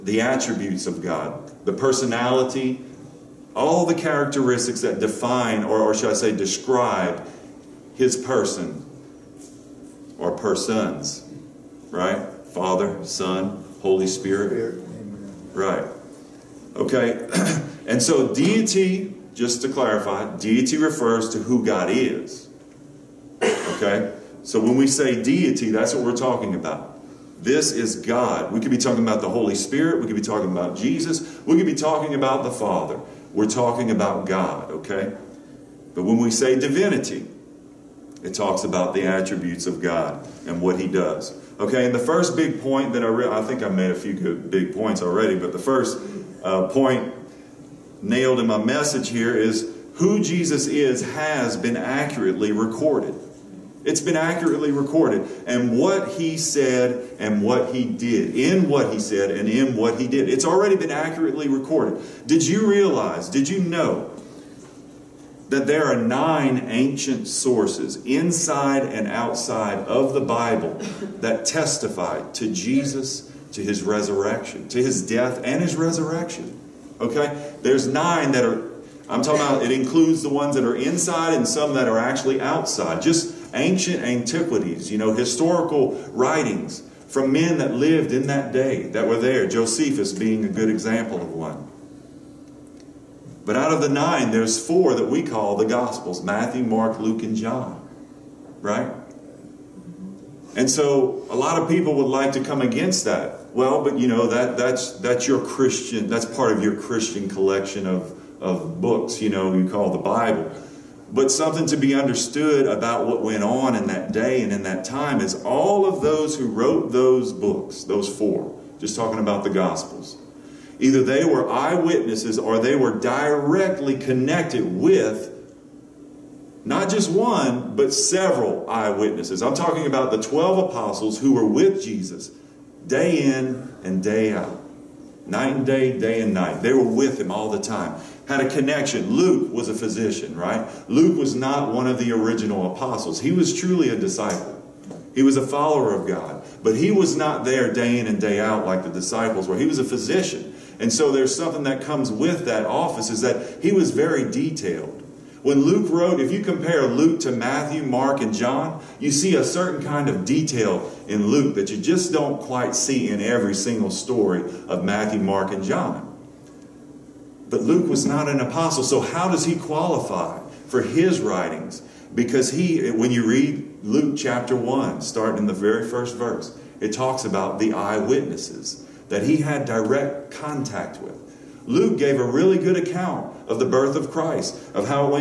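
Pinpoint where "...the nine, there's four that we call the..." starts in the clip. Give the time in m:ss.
1:33.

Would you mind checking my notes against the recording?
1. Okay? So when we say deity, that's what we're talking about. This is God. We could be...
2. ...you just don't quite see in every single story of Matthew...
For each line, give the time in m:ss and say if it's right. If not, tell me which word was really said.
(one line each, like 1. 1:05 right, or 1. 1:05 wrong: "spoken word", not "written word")
1. 0:23 right
2. 2:41 right.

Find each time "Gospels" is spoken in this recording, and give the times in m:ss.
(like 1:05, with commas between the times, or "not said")
1:35, 1:59.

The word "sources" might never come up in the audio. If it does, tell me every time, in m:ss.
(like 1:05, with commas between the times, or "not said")
1:07.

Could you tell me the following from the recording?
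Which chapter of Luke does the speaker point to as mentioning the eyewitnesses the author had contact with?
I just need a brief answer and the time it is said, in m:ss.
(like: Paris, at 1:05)
Chapter 1, at 2:54.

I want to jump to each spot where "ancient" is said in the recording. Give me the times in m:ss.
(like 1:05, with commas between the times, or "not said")
1:06, 1:23.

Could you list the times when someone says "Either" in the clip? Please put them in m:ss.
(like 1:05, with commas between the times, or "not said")
2:00.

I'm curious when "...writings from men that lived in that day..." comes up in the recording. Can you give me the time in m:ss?
1:26.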